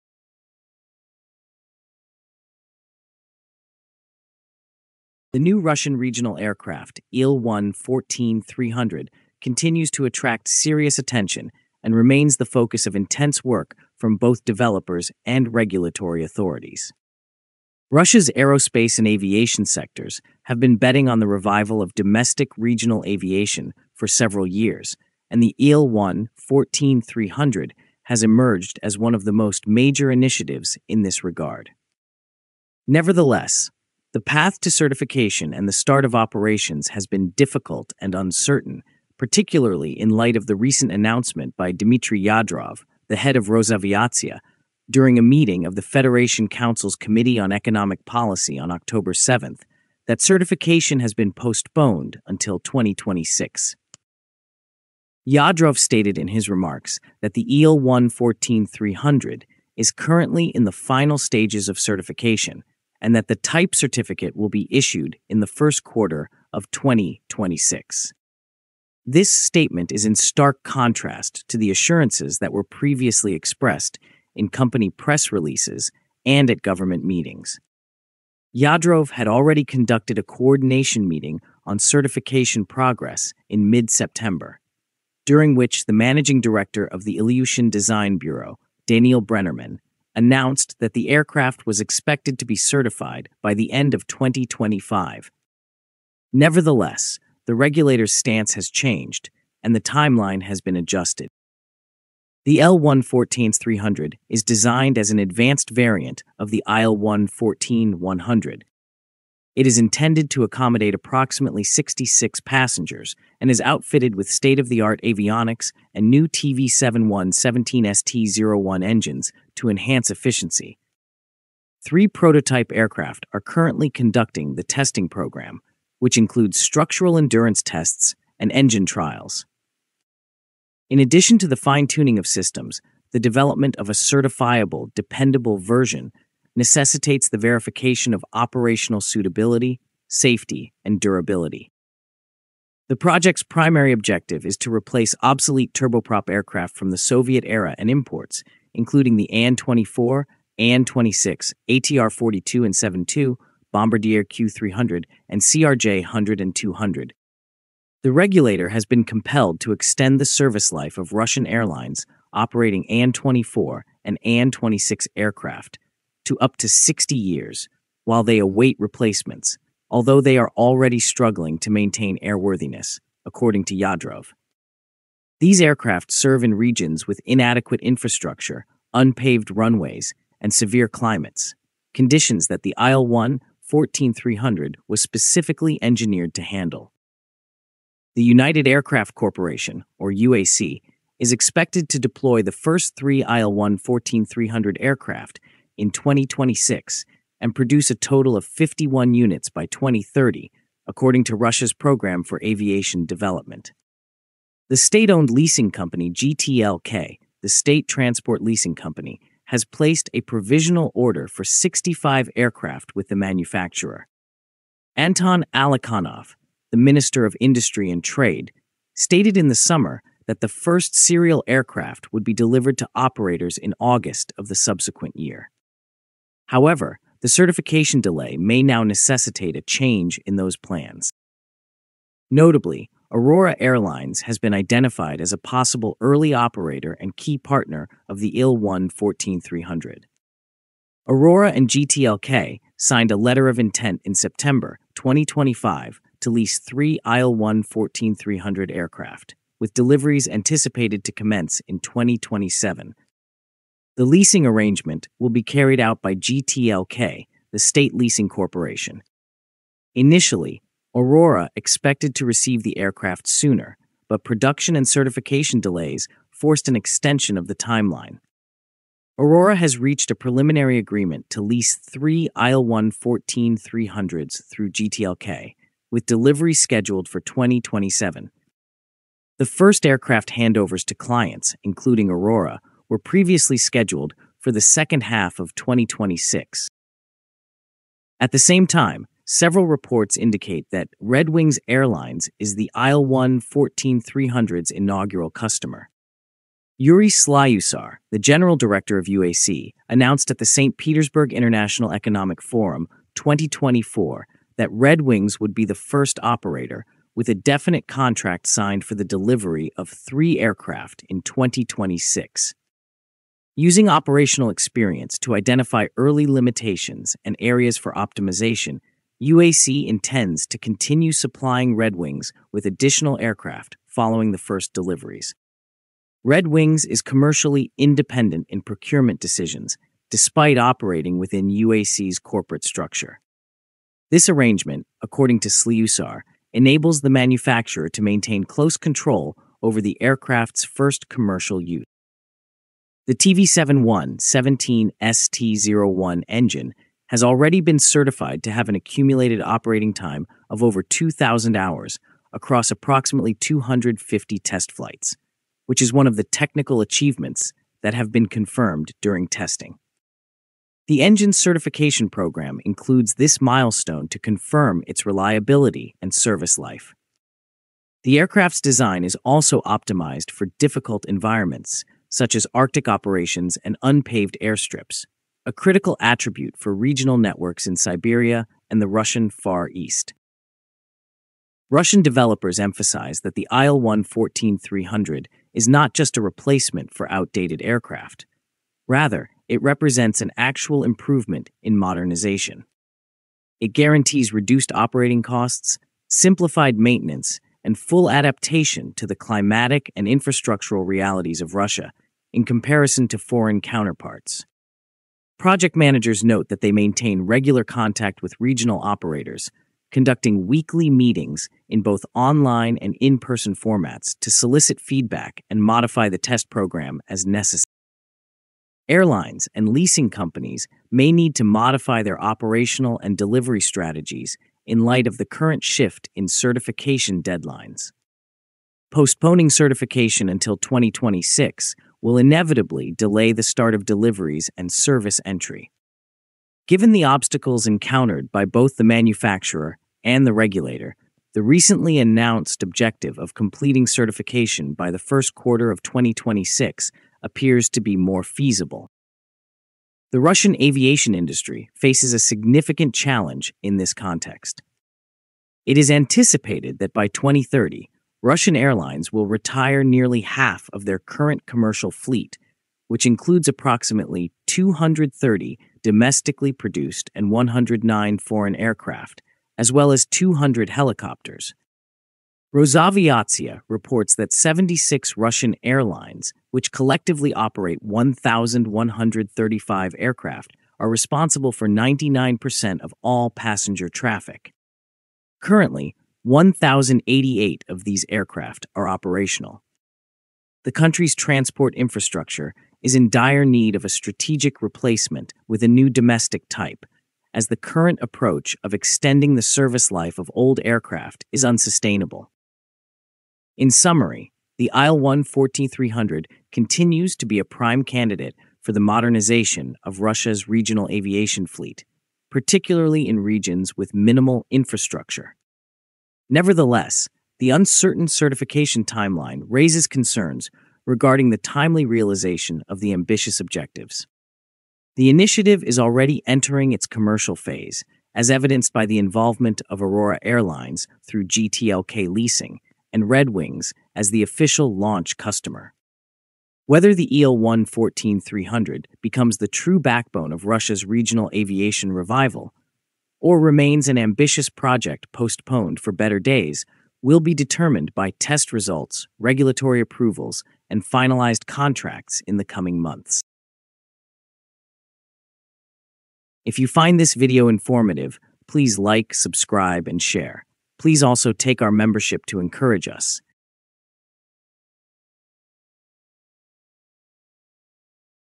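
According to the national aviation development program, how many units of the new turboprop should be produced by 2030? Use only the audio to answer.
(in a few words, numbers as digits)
51.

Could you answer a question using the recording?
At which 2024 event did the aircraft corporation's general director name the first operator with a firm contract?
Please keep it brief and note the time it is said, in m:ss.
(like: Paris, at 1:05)
St. Petersburg International Economic Forum, at 5:00.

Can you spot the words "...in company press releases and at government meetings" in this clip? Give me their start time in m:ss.
1:14.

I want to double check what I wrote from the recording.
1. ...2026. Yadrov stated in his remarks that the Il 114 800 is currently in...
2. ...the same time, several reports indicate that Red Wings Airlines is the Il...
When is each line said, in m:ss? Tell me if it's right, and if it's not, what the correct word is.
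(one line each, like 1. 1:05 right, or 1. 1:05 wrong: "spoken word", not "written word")
1. 0:52 wrong: "300", not "800"
2. 4:48 right.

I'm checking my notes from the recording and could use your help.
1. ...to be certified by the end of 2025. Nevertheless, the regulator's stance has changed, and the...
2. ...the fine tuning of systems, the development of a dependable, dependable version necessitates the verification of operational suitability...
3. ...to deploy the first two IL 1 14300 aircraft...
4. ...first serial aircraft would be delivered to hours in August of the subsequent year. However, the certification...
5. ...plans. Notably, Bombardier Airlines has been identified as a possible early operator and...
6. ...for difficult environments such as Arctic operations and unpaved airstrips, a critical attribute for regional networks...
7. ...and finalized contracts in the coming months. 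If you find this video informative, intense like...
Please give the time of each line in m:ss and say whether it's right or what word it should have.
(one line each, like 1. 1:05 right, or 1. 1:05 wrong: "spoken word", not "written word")
1. 1:32 right
2. 2:11 wrong: "certifiable", not "dependable"
3. 3:11 wrong: "three", not "two"
4. 3:40 wrong: "operators", not "hours"
5. 3:50 wrong: "Aurora", not "Bombardier"
6. 6:10 right
7. 9:10 wrong: "please", not "intense".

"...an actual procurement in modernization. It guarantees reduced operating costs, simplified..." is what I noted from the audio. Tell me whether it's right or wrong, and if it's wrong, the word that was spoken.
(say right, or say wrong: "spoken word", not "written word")
wrong: "improvement", not "procurement".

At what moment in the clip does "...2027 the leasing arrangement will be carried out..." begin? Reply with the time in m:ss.
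4:11.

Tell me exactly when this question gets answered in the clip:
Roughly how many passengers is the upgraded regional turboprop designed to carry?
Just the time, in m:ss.
1:51.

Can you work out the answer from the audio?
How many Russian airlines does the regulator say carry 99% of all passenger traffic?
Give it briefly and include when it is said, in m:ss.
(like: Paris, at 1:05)
76, at 7:54.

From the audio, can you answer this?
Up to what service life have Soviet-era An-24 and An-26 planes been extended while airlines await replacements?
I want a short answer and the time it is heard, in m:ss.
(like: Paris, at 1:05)
60 years, at 2:46.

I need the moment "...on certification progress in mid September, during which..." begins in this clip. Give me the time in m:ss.
1:21.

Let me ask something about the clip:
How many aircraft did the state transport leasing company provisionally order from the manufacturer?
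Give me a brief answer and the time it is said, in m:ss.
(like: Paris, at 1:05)
65, at 3:31.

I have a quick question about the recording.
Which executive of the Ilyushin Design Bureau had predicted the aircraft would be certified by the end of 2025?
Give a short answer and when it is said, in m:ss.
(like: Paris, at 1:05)
Daniel Brennerman, at 1:28.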